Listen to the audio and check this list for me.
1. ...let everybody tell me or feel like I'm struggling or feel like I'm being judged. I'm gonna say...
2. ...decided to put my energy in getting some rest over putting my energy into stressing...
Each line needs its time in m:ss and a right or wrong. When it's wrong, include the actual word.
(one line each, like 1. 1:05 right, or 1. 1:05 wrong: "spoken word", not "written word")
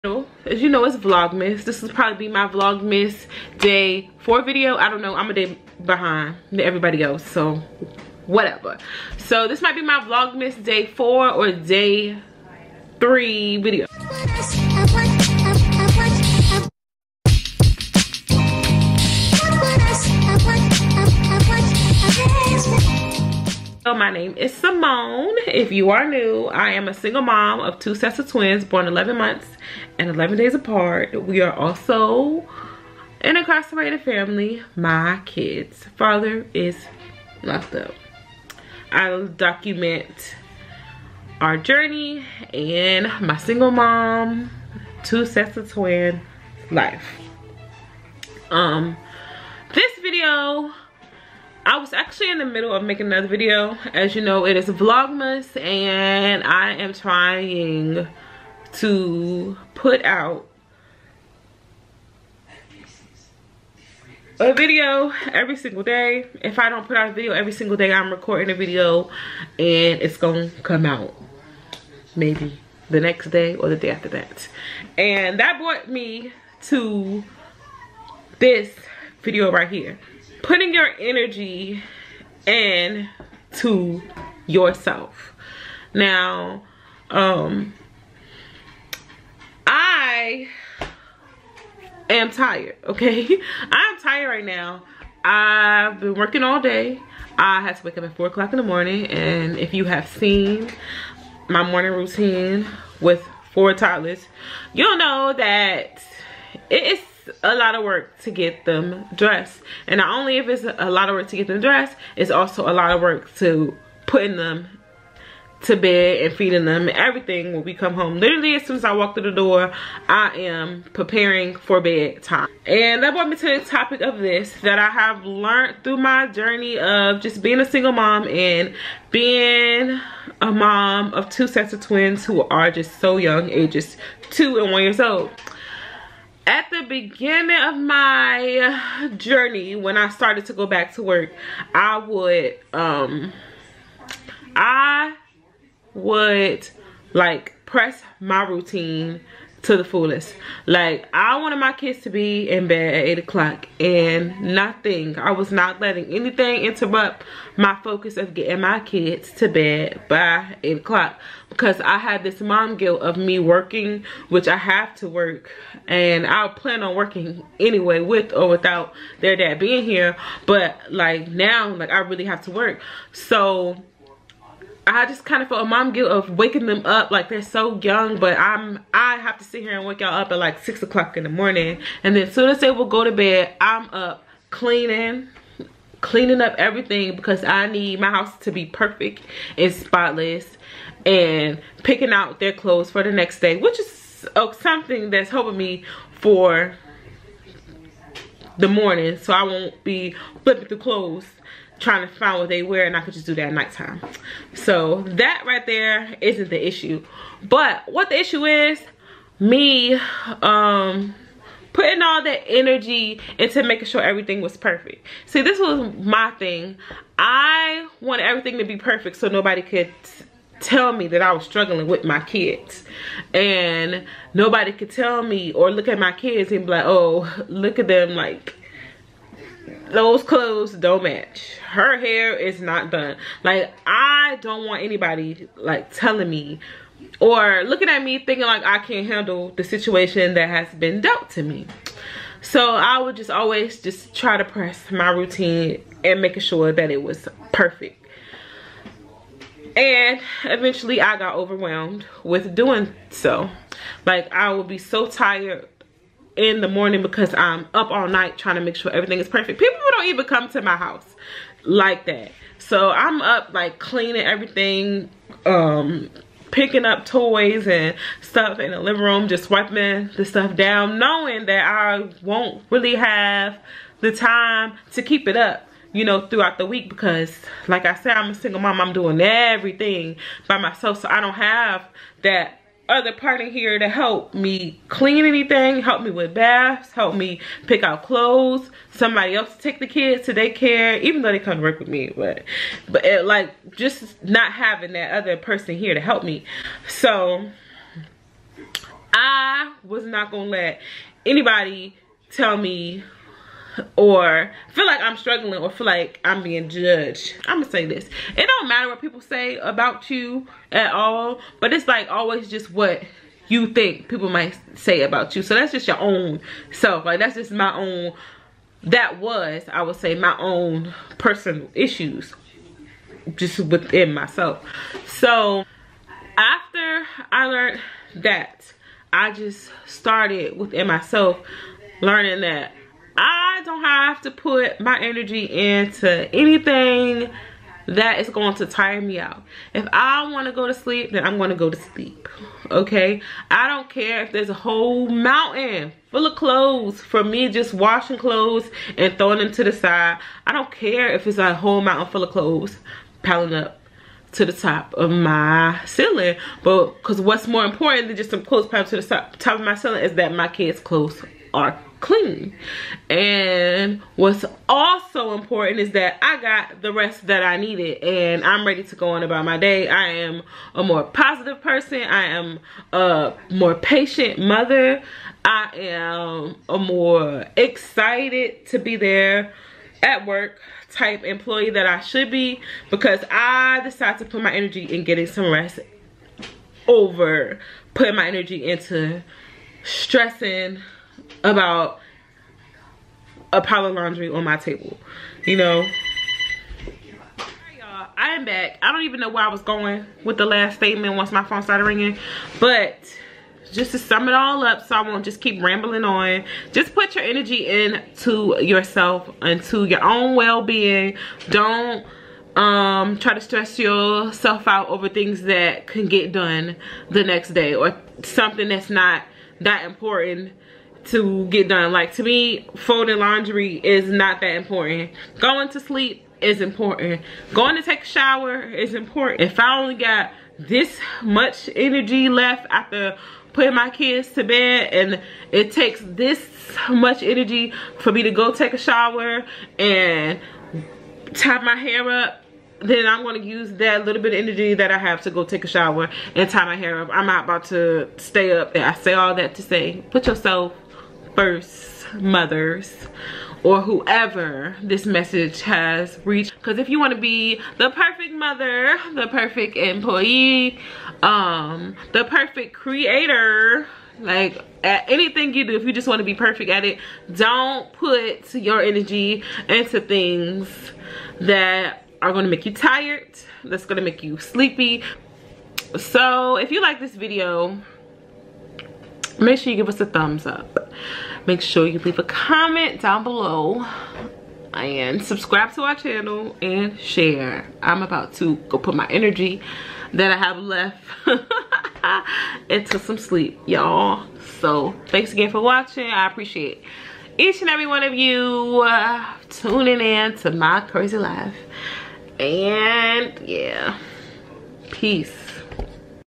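1. 5:00 wrong: "anybody", not "everybody"
2. 6:23 right.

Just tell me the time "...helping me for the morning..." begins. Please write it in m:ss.
3:15.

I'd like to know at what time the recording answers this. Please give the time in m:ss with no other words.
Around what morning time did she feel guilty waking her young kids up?
3:00.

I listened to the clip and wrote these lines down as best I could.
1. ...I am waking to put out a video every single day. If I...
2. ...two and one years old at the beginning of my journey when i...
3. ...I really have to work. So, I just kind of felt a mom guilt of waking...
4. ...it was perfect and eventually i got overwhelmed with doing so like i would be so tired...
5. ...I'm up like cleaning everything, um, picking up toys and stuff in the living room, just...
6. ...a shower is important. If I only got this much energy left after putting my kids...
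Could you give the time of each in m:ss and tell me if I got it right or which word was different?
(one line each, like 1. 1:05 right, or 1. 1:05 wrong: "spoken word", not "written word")
1. 0:56 wrong: "trying", not "waking"
2. 2:14 right
3. 2:51 right
4. 4:06 right
5. 4:22 right
6. 7:08 right.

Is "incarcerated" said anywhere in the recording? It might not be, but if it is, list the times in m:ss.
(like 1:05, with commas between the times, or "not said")
0:33.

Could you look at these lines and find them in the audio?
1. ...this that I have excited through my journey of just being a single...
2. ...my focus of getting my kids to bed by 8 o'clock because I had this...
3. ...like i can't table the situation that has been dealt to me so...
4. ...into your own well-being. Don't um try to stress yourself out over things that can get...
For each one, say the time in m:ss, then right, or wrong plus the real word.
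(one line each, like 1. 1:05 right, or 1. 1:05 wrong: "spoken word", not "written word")
1. 2:04 wrong: "learned", not "excited"
2. 2:37 right
3. 3:58 wrong: "handle", not "table"
4. 6:49 right.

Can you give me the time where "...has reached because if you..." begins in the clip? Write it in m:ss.
7:35.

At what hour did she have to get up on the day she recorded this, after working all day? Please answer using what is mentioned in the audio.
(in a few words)
4 o'clock.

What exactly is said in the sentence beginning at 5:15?
So that's just your own self.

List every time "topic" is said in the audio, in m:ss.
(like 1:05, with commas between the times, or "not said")
2:03.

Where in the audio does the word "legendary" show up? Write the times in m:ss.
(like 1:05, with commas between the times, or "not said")
not said.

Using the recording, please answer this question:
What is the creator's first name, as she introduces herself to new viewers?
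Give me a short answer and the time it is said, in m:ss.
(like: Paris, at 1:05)
Symone, at 0:24.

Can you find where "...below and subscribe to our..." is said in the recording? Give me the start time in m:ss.
8:03.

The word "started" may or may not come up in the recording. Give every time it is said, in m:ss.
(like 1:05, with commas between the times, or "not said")
2:20, 5:29, 6:41.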